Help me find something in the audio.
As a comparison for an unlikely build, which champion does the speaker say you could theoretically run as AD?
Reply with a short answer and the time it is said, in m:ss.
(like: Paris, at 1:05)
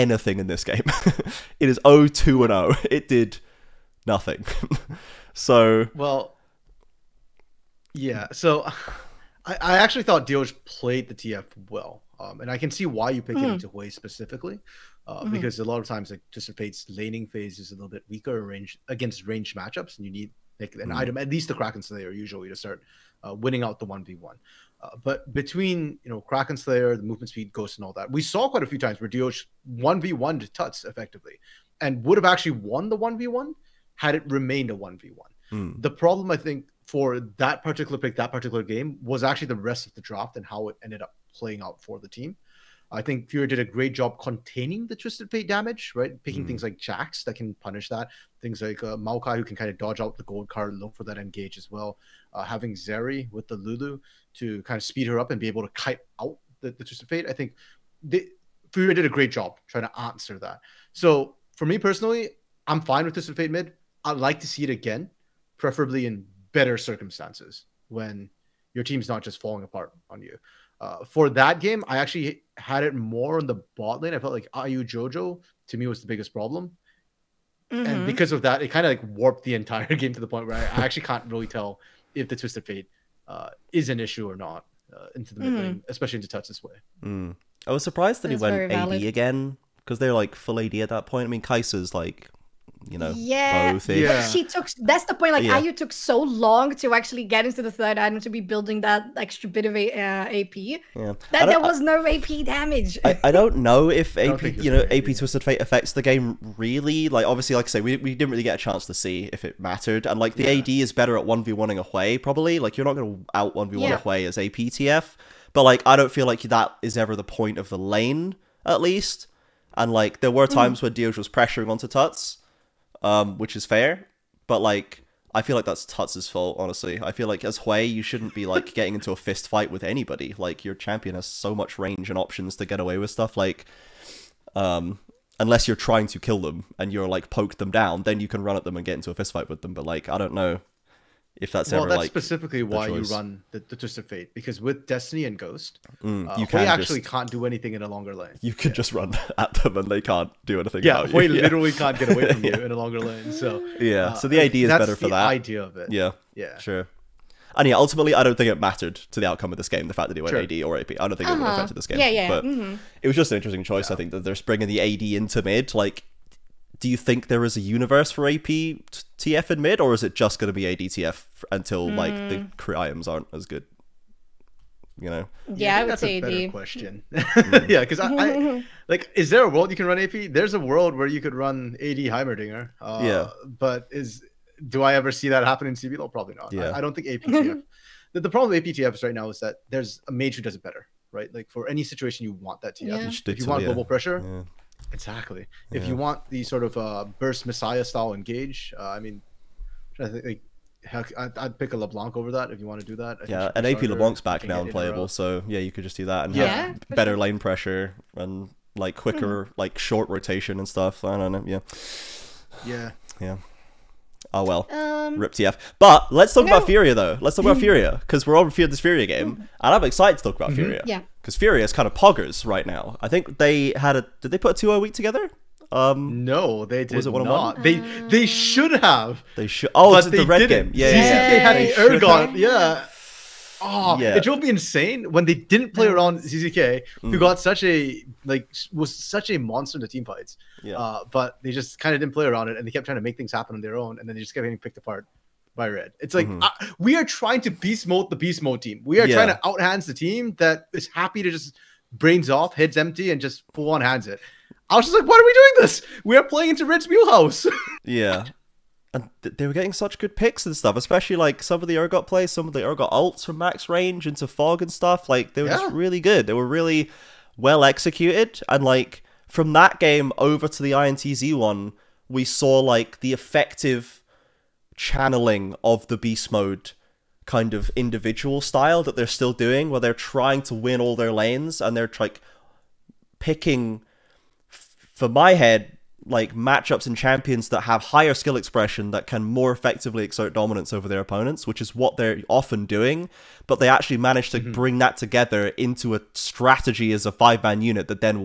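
Heimerdinger, at 3:01.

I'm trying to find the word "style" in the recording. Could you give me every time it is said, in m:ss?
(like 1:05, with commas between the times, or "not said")
3:17, 4:38.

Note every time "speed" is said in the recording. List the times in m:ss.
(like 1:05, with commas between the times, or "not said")
0:27, 0:54.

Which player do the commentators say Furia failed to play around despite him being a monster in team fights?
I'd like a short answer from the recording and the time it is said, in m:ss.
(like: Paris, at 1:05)
ZZK, at 3:56.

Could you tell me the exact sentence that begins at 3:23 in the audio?
I yeah, an AP LeBlanc's back now and playable, so yeah, you could just do that and yeah.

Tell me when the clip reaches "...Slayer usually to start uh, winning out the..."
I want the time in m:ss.
0:21.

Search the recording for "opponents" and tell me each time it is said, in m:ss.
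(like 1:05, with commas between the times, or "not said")
4:51.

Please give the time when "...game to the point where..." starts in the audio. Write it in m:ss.
1:19.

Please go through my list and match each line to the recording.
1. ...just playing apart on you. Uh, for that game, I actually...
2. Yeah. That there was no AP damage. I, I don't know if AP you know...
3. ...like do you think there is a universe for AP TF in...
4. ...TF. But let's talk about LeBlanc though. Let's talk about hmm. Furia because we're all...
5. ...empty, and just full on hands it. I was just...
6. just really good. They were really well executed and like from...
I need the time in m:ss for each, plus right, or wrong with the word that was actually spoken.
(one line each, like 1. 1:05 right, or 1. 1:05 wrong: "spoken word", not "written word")
1. 1:09 wrong: "falling", not "playing"
2. 1:40 right
3. 2:45 right
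4. 3:35 wrong: "Furia", not "LeBlanc"
5. 4:12 right
6. 4:25 right.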